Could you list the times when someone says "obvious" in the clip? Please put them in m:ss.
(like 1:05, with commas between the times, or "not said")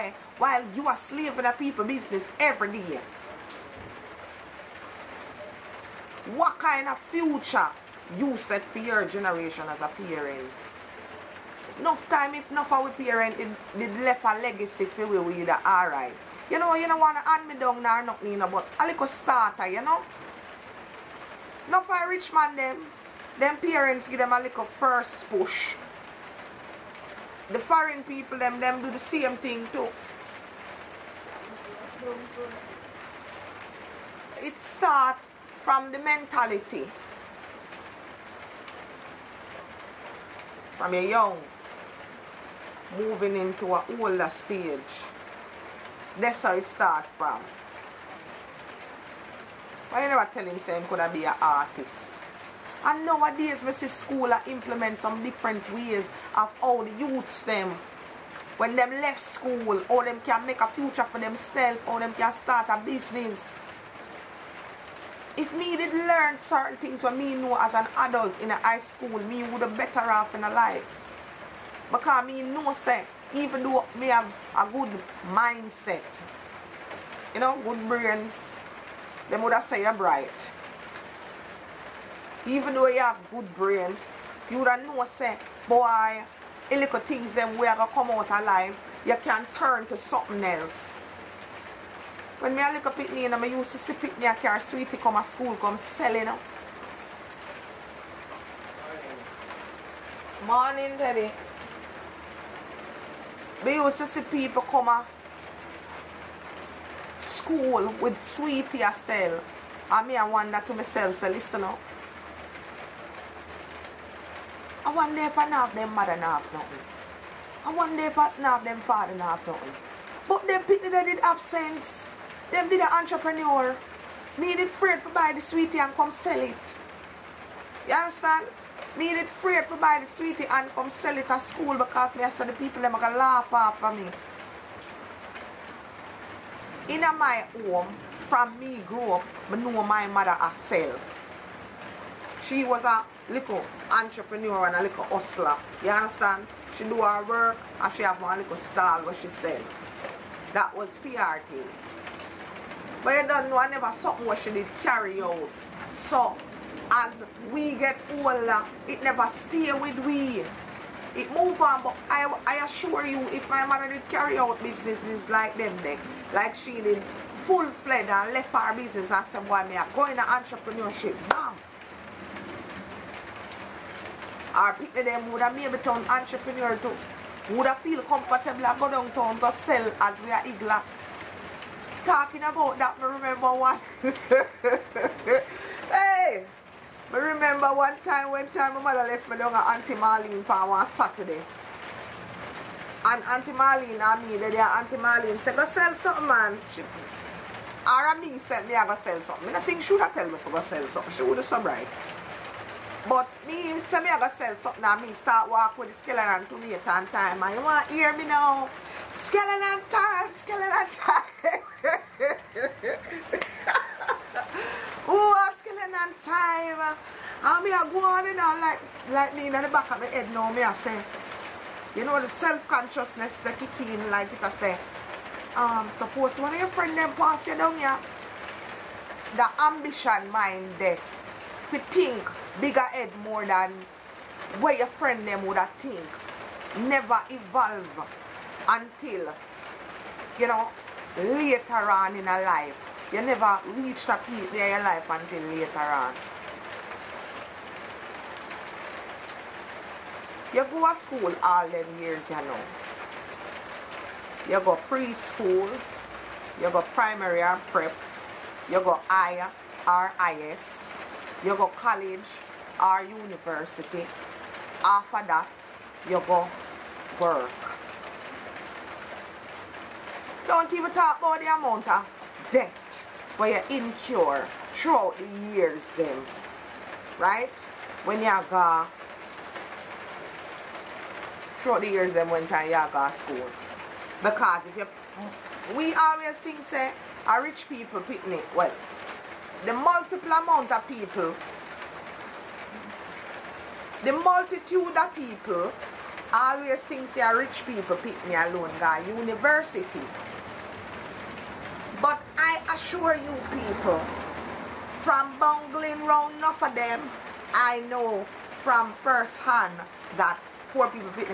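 not said.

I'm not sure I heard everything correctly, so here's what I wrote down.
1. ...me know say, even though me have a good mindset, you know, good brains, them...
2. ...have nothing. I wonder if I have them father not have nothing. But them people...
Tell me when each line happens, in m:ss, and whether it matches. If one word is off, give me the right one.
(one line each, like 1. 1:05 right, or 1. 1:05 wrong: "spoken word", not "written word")
1. 1:12 right
2. 1:56 right.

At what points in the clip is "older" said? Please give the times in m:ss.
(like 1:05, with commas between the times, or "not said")
0:43, 2:38.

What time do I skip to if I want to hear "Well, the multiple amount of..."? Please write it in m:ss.
4:48.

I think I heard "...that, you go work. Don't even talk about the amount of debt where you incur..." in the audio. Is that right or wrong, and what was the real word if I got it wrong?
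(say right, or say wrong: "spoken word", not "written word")
right.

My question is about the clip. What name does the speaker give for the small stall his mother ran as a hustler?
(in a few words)
PRT.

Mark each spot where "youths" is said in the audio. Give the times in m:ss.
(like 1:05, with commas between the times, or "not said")
0:56.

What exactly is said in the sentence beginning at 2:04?
Needed fruit to buy the sweetie and come sell it.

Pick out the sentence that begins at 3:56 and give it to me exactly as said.
Never evolve until, you know, later on in a life you never reach that peak there in your life until later on.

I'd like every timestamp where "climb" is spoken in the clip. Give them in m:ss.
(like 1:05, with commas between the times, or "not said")
not said.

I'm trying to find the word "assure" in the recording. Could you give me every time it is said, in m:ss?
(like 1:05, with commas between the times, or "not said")
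2:42, 5:02.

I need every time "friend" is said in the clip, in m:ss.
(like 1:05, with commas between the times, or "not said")
3:46, 3:54.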